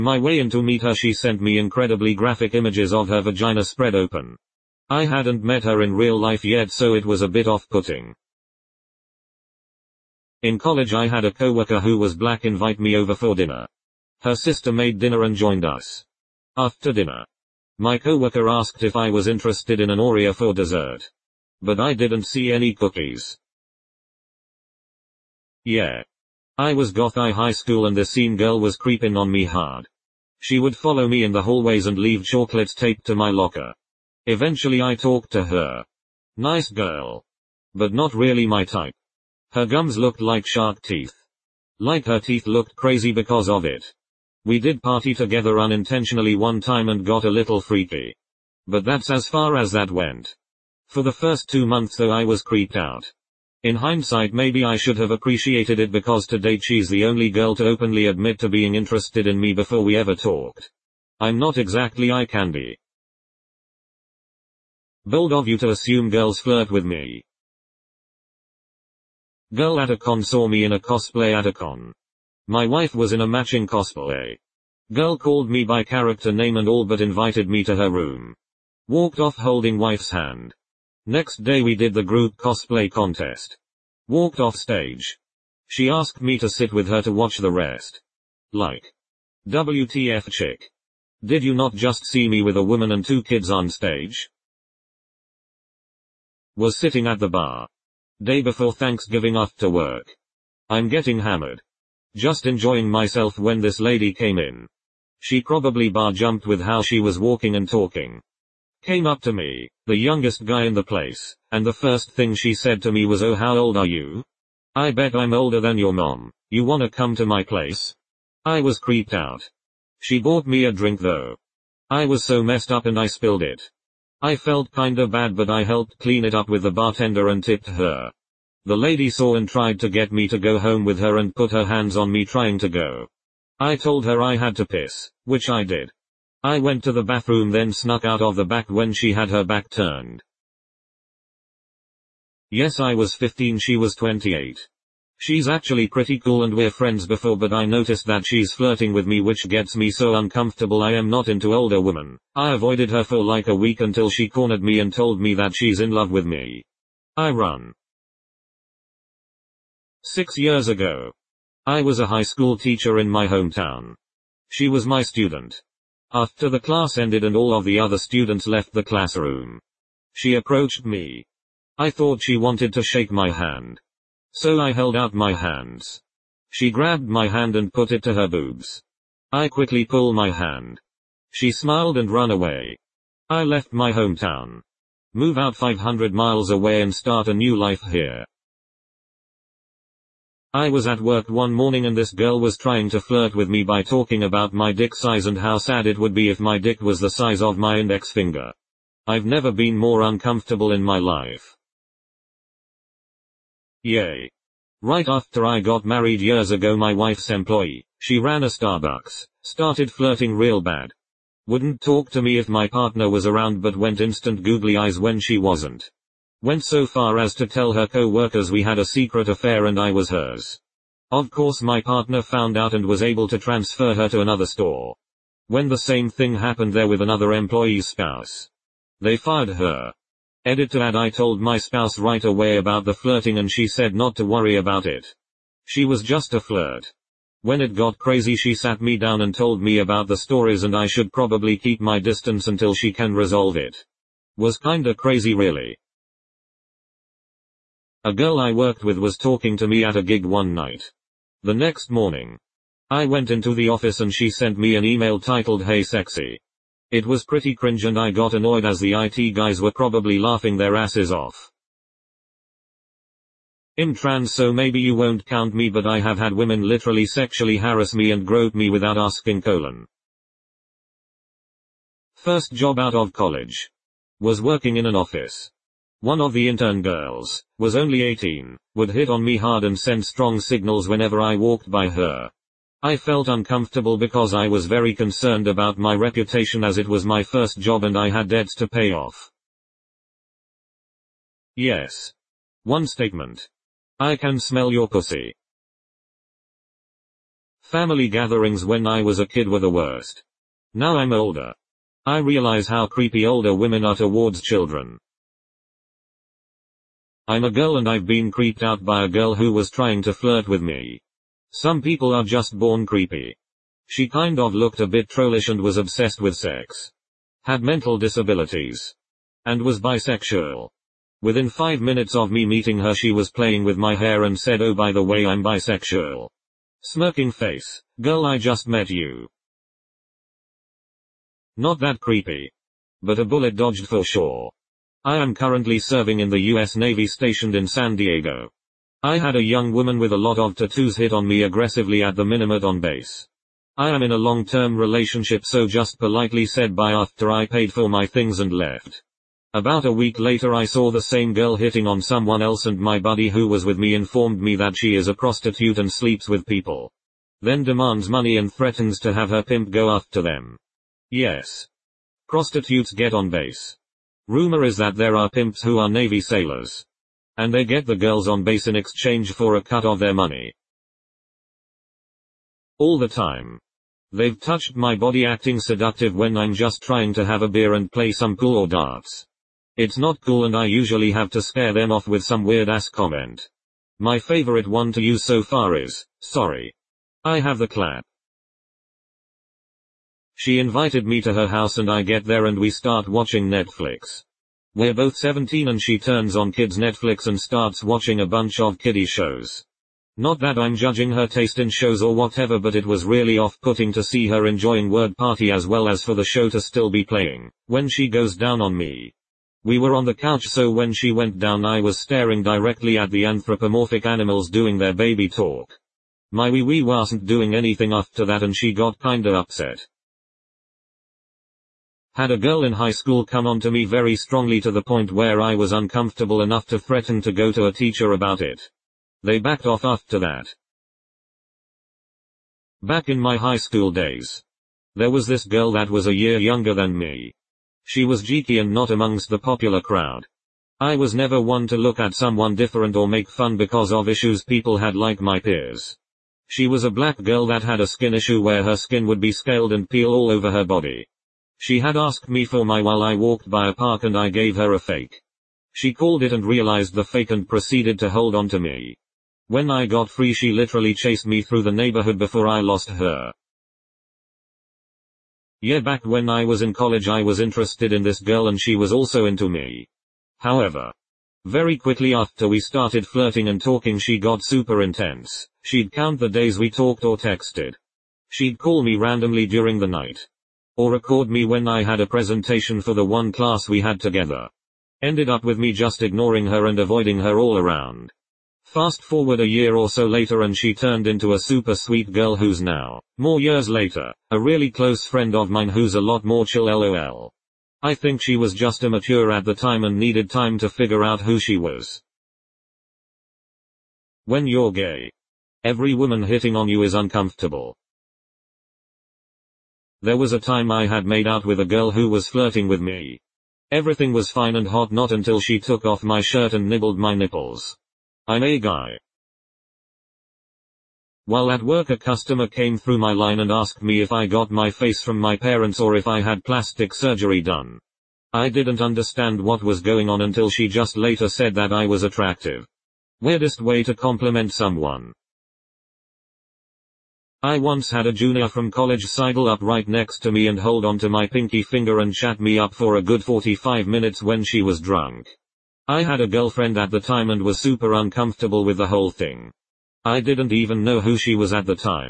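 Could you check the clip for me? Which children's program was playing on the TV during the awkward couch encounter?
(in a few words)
Word Party.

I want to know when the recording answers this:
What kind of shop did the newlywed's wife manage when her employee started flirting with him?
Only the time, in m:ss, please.
3:28.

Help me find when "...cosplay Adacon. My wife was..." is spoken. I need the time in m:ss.
1:10.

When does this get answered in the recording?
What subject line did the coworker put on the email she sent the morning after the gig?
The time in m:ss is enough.
4:15.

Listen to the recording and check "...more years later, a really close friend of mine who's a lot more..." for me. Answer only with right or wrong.
right.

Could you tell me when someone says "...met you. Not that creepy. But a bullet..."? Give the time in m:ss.
5:28.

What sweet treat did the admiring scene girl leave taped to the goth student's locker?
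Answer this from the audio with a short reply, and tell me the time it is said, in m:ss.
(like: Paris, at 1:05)
chocolate, at 0:32.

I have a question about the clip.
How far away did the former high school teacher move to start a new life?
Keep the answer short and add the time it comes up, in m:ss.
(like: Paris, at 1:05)
500 miles, at 3:05.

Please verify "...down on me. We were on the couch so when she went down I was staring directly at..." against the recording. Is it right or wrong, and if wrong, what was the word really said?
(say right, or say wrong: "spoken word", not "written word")
right.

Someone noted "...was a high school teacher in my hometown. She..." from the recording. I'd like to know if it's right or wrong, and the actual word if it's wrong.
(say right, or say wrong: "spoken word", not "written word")
right.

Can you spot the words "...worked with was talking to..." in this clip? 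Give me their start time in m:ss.
4:08.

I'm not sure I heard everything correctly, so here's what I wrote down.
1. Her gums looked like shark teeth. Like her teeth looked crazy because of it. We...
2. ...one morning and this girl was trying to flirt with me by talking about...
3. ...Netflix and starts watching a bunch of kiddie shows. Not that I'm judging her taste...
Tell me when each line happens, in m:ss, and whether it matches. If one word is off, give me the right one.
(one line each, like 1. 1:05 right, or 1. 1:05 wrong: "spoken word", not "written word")
1. 0:39 right
2. 3:11 right
3. 6:36 right.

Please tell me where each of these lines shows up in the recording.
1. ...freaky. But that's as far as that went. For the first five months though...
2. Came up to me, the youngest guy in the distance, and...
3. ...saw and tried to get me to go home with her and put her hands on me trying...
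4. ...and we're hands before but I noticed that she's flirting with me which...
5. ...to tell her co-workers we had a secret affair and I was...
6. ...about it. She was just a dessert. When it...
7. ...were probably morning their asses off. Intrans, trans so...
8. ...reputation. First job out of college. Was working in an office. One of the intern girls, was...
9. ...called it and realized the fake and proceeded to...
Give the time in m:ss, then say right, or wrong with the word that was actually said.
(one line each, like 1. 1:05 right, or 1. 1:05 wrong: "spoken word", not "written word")
1. 0:47 wrong: "two", not "five"
2. 1:48 wrong: "place", not "distance"
3. 2:09 right
4. 2:26 wrong: "friends", not "hands"
5. 3:37 right
6. 3:54 wrong: "flirt", not "dessert"
7. 4:19 wrong: "laughing", not "morning"
8. 4:29 wrong: "colon", not "reputation"
9. 7:35 right.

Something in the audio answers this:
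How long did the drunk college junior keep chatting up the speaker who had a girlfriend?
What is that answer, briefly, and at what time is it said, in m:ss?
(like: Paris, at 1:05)
45 minutes, at 9:03.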